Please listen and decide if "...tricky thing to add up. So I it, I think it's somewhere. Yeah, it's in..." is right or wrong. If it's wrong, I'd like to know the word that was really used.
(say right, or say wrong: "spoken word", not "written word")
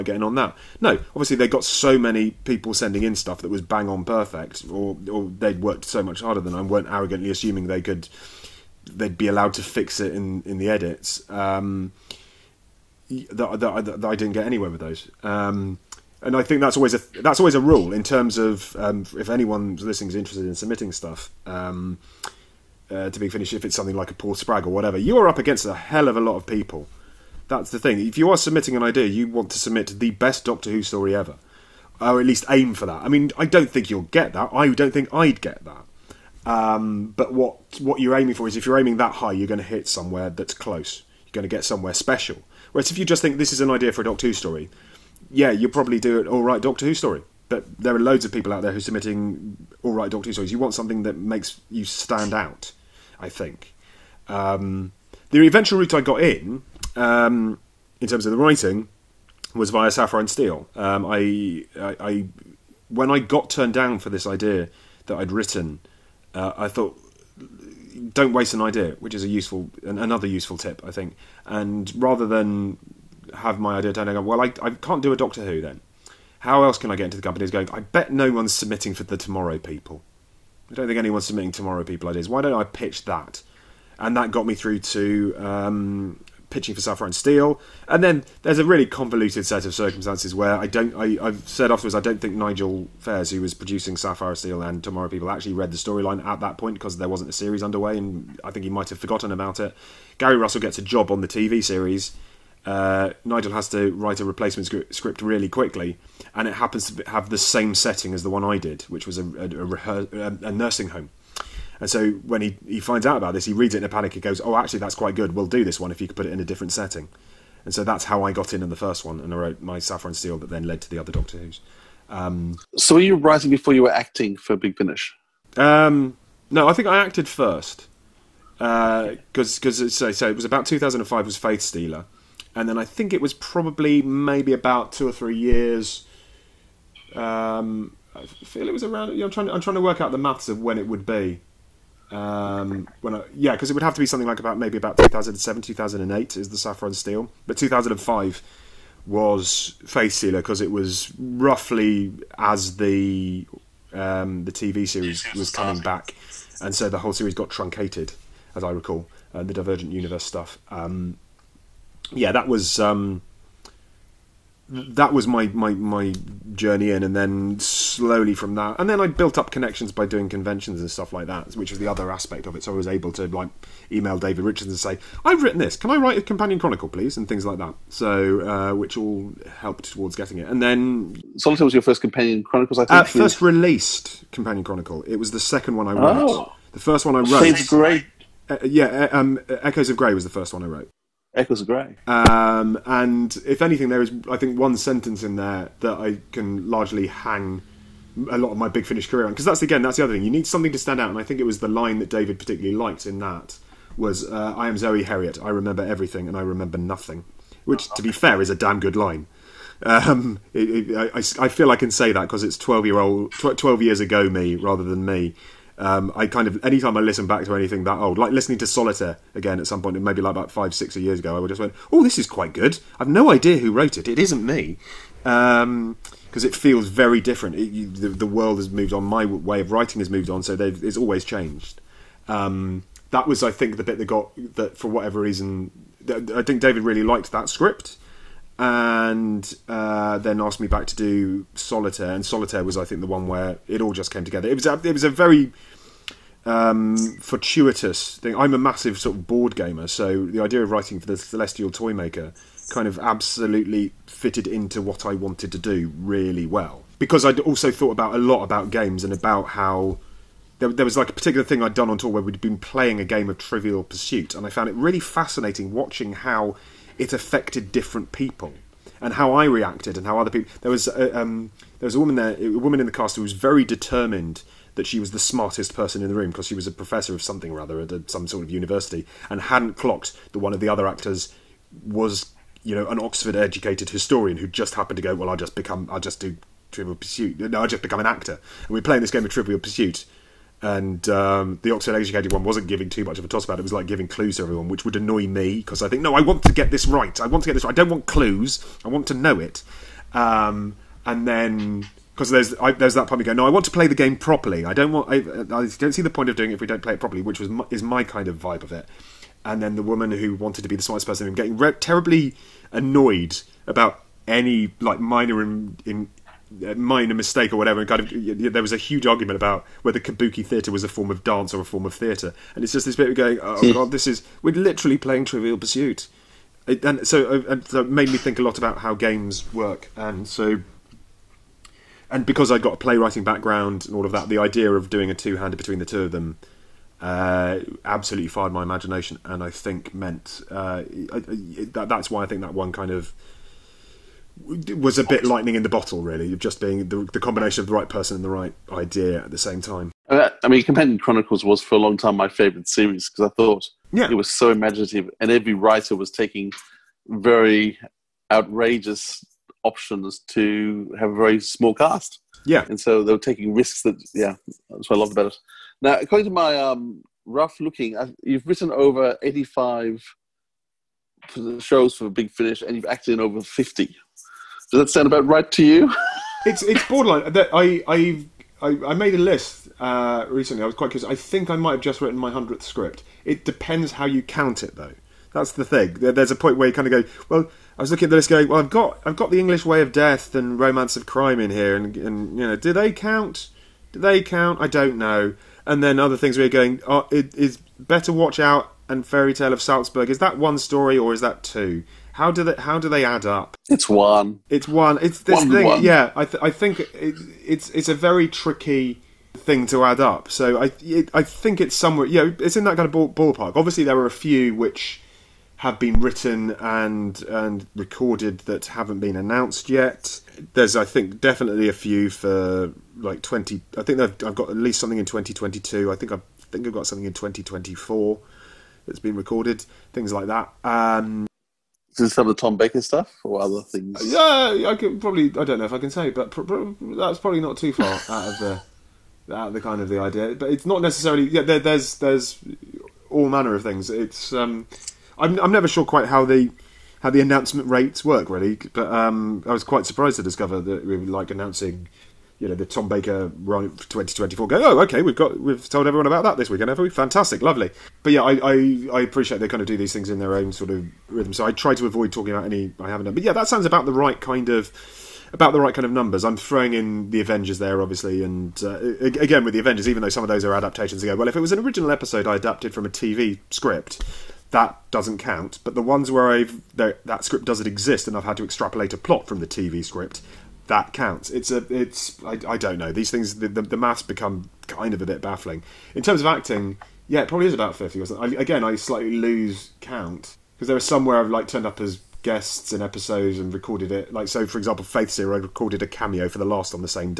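right.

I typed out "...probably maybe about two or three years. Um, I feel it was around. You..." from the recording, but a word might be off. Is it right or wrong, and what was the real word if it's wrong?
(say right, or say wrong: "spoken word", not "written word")
right.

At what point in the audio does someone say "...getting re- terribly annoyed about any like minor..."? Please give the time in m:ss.
5:11.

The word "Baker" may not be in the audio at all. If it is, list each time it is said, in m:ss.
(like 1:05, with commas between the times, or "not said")
7:12, 7:32.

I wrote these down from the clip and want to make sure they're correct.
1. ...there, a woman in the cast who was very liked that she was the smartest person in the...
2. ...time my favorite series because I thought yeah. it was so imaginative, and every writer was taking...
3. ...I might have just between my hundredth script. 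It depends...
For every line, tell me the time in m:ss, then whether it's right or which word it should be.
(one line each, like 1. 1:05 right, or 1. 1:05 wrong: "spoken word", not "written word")
1. 4:32 wrong: "determined", not "liked"
2. 5:51 right
3. 6:21 wrong: "written", not "between".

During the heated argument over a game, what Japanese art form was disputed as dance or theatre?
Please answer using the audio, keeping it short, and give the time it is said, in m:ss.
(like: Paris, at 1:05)
Kabuki, at 5:19.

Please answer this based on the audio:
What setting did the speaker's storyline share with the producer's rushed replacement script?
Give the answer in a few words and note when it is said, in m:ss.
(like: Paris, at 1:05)
A nursing home, at 1:50.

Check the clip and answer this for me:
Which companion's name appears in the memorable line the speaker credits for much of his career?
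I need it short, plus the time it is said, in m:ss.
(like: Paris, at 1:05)
Zoe Heriot, at 3:24.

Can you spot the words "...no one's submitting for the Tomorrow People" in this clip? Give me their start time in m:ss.
1:18.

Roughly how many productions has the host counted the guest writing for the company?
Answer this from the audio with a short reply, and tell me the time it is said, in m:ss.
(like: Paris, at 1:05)
85, at 6:09.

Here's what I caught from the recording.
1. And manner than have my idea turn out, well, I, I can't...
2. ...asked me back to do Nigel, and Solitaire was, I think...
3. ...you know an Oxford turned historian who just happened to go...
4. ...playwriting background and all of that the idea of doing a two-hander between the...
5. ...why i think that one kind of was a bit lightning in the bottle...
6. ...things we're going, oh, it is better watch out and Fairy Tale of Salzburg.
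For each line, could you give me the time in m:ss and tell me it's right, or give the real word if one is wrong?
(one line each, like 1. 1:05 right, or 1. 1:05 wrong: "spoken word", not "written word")
1. 1:11 wrong: "rather", not "manner"
2. 4:00 wrong: "Solitaire", not "Nigel"
3. 4:42 wrong: "educated", not "turned"
4. 5:32 right
5. 5:42 right
6. 6:36 right.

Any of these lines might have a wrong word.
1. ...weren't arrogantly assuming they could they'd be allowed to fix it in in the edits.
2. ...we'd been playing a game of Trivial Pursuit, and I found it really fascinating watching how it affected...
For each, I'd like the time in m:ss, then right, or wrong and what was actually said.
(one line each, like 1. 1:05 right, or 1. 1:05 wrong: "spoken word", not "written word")
1. 0:06 right
2. 4:22 right.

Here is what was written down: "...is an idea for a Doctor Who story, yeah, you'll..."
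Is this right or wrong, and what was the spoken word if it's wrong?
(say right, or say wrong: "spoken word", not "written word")
right.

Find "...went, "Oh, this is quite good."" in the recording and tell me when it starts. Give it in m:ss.
3:41.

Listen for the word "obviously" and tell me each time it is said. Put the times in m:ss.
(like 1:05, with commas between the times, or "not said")
0:01, 6:53, 7:47.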